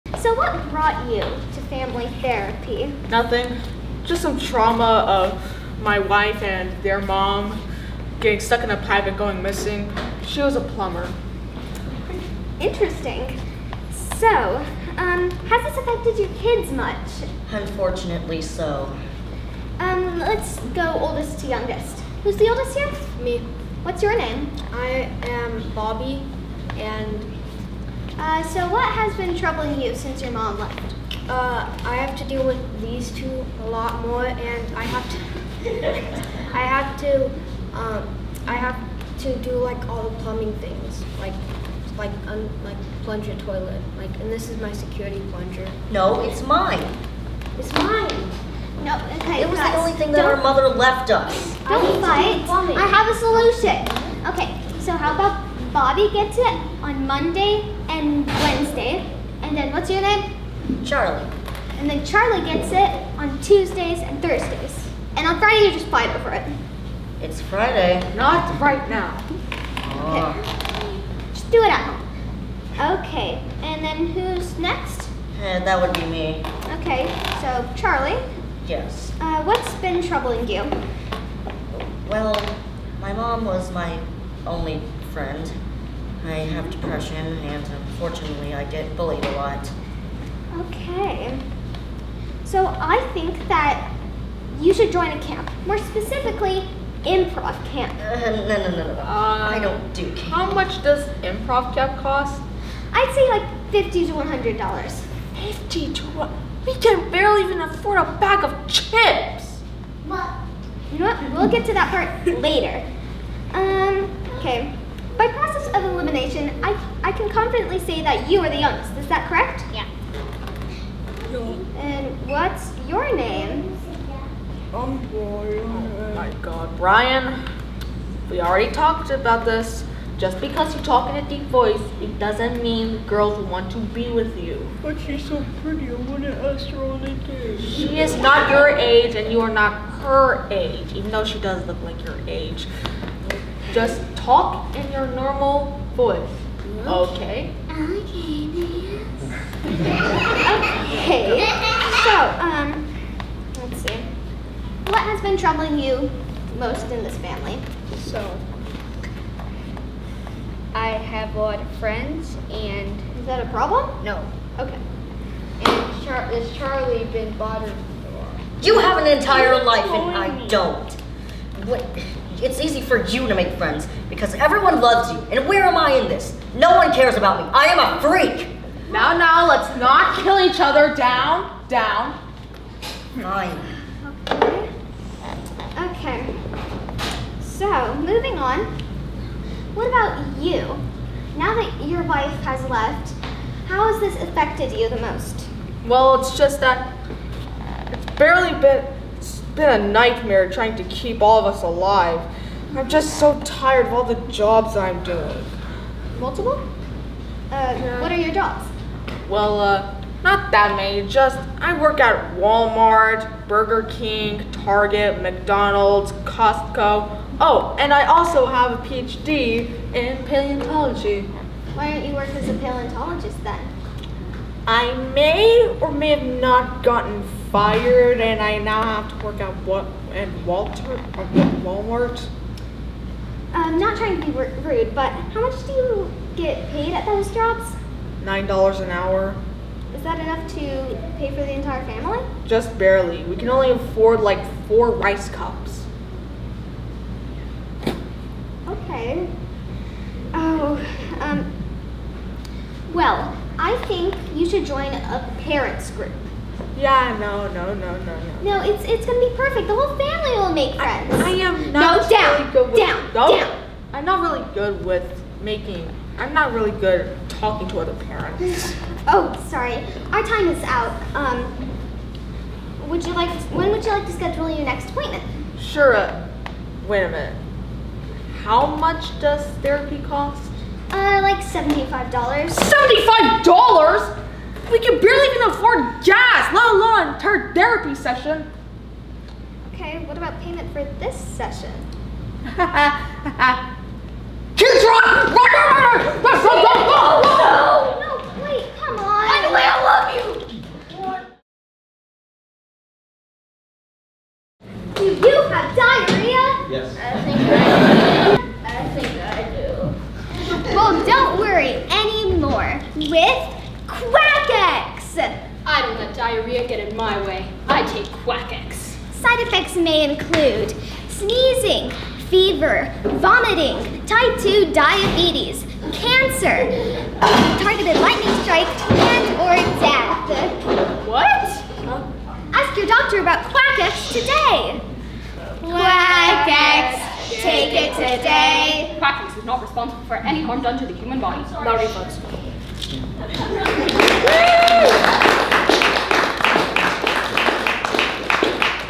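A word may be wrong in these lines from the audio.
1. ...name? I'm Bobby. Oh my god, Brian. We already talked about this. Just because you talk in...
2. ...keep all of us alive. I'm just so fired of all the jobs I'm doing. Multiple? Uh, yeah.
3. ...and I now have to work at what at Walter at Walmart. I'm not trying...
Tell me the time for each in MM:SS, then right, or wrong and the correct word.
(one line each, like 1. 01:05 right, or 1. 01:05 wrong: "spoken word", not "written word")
1. 02:03 wrong: "Brian", not "Bobby"
2. 03:20 wrong: "tired", not "fired"
3. 03:48 right.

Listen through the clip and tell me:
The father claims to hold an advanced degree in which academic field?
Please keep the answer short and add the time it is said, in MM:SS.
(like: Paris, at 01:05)
Paleontology, at 03:40.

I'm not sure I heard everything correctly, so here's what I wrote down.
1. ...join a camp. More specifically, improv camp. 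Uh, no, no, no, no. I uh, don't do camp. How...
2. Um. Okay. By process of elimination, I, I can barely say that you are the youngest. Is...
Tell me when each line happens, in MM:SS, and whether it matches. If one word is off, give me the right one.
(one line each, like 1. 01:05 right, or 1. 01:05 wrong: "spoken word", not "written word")
1. 01:34 right
2. 01:53 wrong: "confidently", not "barely".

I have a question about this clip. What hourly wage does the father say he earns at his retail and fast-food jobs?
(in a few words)
$9 an hour.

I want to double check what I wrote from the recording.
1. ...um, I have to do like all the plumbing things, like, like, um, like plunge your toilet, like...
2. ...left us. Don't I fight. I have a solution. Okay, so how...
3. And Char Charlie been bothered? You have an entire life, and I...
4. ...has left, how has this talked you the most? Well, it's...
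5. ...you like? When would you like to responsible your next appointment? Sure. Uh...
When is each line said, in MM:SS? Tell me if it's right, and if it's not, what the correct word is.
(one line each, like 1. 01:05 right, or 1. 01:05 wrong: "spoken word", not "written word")
1. 00:37 right
2. 00:50 right
3. 02:45 right
4. 03:12 wrong: "affected", not "talked"
5. 04:33 wrong: "schedule", not "responsible".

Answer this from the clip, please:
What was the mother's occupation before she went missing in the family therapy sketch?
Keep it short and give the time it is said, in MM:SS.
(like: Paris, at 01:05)
Plumber, at 00:10.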